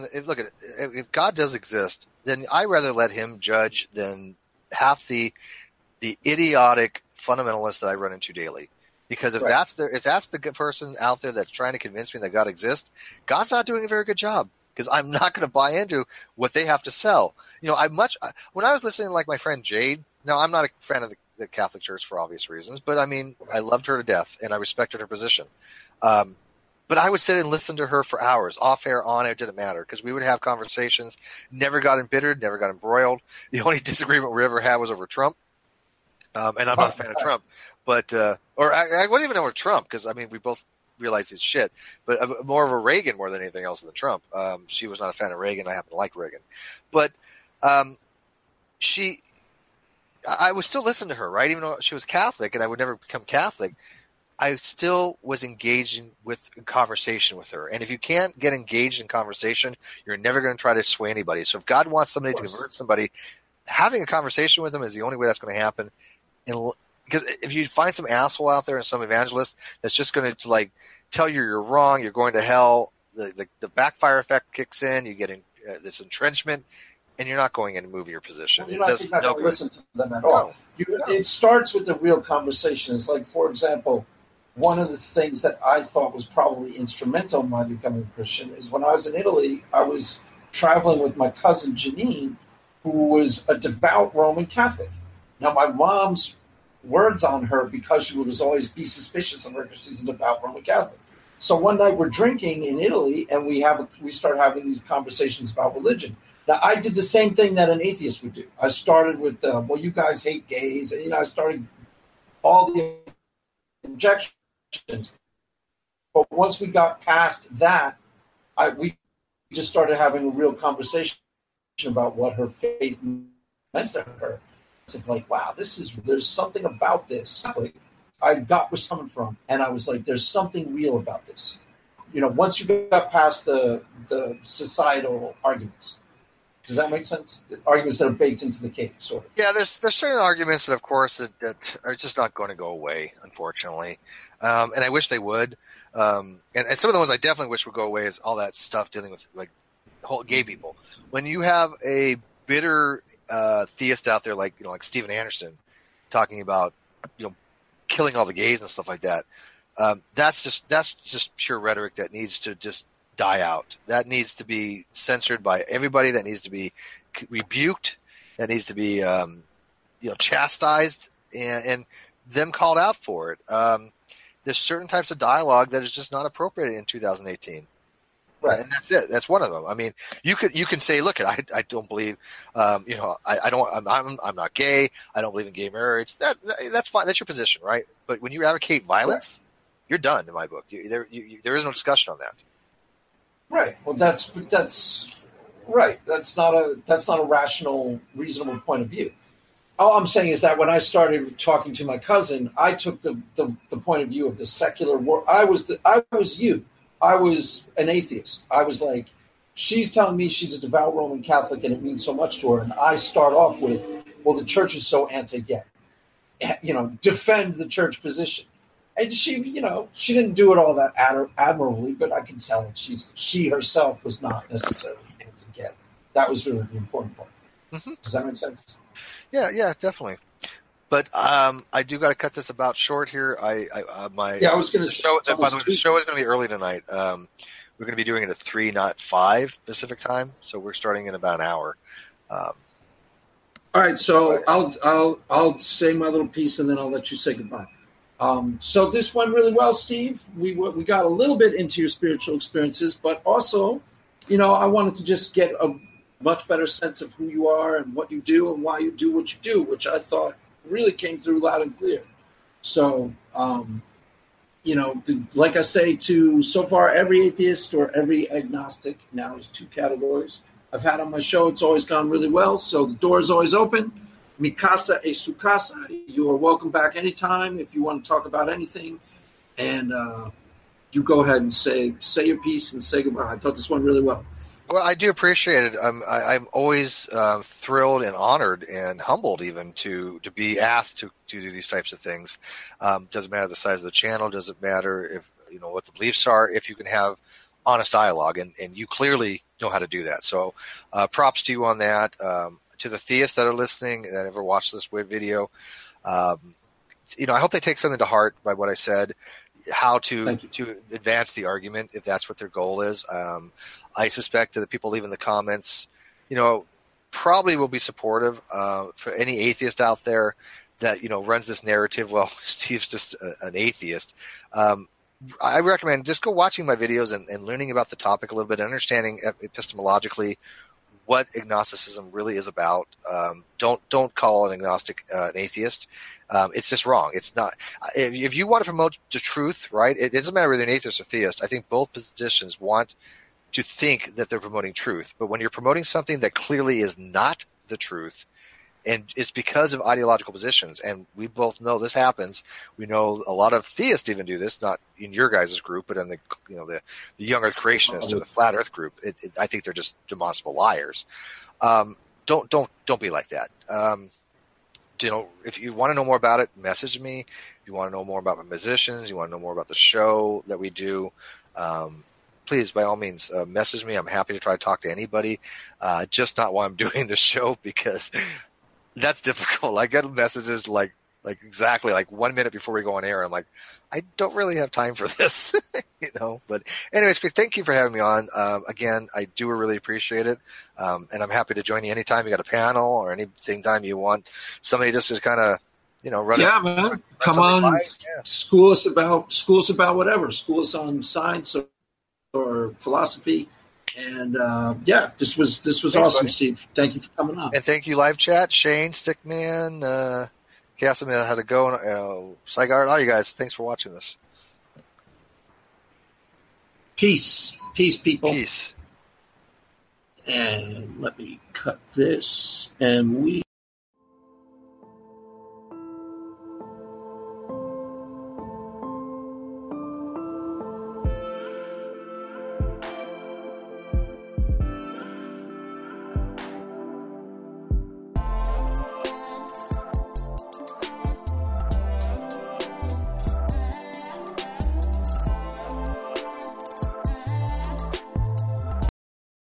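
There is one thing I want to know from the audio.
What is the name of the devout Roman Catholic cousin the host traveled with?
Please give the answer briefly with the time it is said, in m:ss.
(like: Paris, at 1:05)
Janine, at 1:31.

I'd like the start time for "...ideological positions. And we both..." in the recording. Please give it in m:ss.
5:49.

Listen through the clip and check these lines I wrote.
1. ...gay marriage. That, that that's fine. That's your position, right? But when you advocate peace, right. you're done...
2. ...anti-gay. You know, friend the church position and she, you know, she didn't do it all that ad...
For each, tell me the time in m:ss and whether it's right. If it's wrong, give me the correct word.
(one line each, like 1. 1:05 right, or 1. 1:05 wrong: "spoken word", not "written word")
1. 3:05 wrong: "violence", not "peace"
2. 3:35 wrong: "defend", not "friend".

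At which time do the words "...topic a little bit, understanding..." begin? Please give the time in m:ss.
5:27.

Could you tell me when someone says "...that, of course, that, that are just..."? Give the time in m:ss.
2:20.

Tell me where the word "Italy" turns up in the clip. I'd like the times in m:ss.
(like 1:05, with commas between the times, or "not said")
1:29, 1:42.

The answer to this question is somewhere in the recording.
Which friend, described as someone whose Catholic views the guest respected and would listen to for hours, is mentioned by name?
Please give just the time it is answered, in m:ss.
0:19.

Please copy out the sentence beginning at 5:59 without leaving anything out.
It, it, I think they're just demonstrable liars.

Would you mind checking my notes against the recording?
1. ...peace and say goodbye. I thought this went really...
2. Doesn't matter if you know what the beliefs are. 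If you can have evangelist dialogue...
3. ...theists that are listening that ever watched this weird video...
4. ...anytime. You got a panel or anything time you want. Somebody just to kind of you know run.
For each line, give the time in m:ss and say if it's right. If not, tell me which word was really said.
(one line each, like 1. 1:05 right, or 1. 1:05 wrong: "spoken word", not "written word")
1. 4:42 wrong: "piece", not "peace"
2. 4:54 wrong: "honest", not "evangelist"
3. 5:02 right
4. 6:31 right.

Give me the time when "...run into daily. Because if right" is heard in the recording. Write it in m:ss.
0:07.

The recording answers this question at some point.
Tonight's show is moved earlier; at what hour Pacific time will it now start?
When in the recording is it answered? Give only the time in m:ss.
3:58.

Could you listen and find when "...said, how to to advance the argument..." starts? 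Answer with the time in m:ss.
5:08.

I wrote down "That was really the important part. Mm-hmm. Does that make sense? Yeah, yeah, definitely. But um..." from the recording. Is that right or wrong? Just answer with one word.
right.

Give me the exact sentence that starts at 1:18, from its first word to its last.
You're it not, not no going to listen to them at no.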